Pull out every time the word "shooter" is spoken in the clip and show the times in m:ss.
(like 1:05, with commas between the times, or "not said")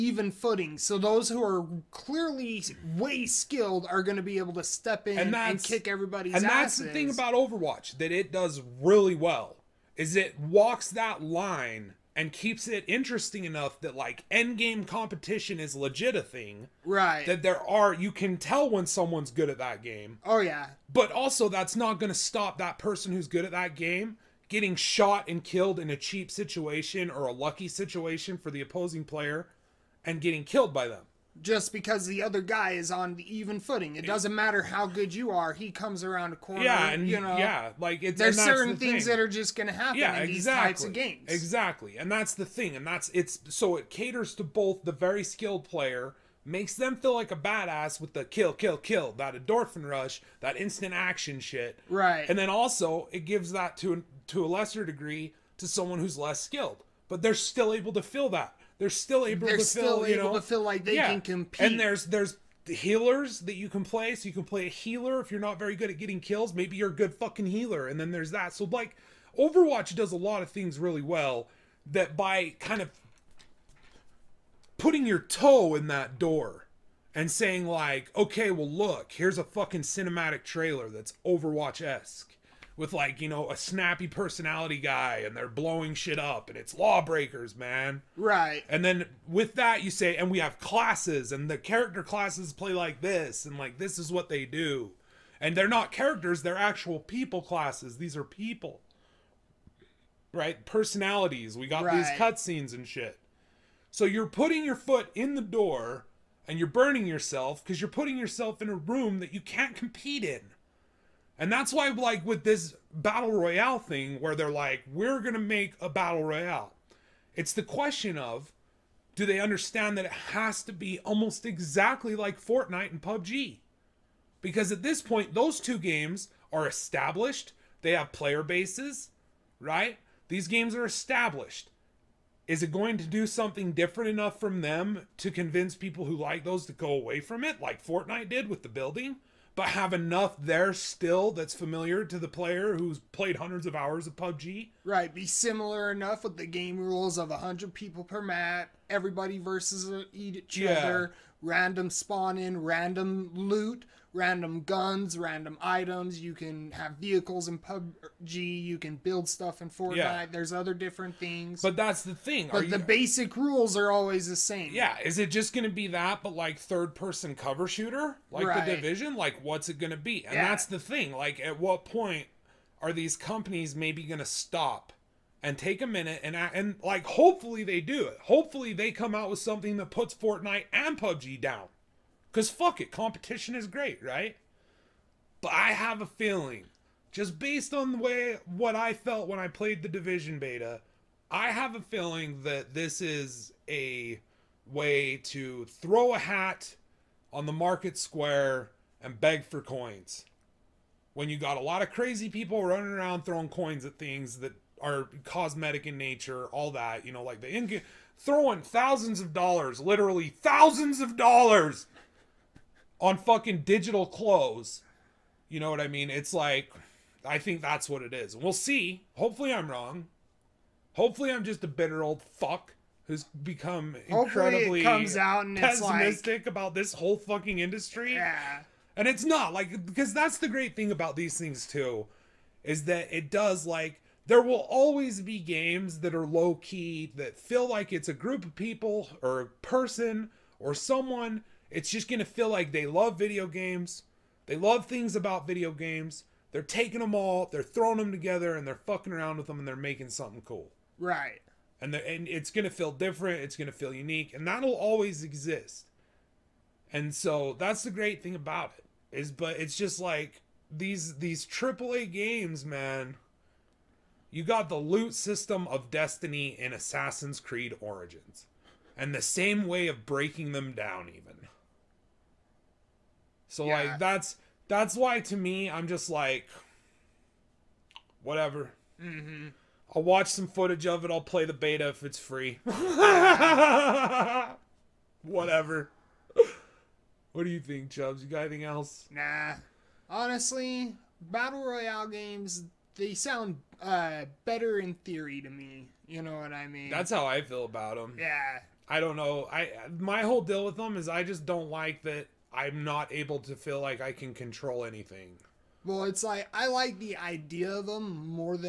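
2:47.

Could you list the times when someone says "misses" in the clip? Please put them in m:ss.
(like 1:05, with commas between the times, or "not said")
not said.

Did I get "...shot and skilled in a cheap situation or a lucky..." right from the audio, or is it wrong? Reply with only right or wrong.
wrong.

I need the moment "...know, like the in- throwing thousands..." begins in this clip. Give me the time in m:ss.
3:27.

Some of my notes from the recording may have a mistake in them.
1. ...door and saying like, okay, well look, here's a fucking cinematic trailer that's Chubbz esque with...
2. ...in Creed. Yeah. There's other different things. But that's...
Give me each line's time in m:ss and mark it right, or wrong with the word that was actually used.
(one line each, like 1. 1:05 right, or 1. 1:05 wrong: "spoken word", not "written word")
1. 1:16 wrong: "Overwatch", not "Chubbz"
2. 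2:39 wrong: "Fortnite", not "Creed".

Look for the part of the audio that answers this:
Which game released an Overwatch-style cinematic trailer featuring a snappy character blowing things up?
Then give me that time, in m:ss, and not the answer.
1:26.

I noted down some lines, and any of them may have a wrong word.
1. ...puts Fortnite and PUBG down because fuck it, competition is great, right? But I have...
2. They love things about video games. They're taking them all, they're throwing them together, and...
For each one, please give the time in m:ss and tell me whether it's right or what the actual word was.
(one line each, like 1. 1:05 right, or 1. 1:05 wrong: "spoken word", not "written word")
1. 2:59 right
2. 4:04 right.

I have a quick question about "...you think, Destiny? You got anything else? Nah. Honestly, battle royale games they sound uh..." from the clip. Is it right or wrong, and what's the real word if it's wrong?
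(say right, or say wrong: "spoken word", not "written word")
wrong: "Chubbz", not "Destiny".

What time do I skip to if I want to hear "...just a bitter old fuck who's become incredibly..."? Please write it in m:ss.
3:41.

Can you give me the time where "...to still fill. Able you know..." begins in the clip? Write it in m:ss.
0:59.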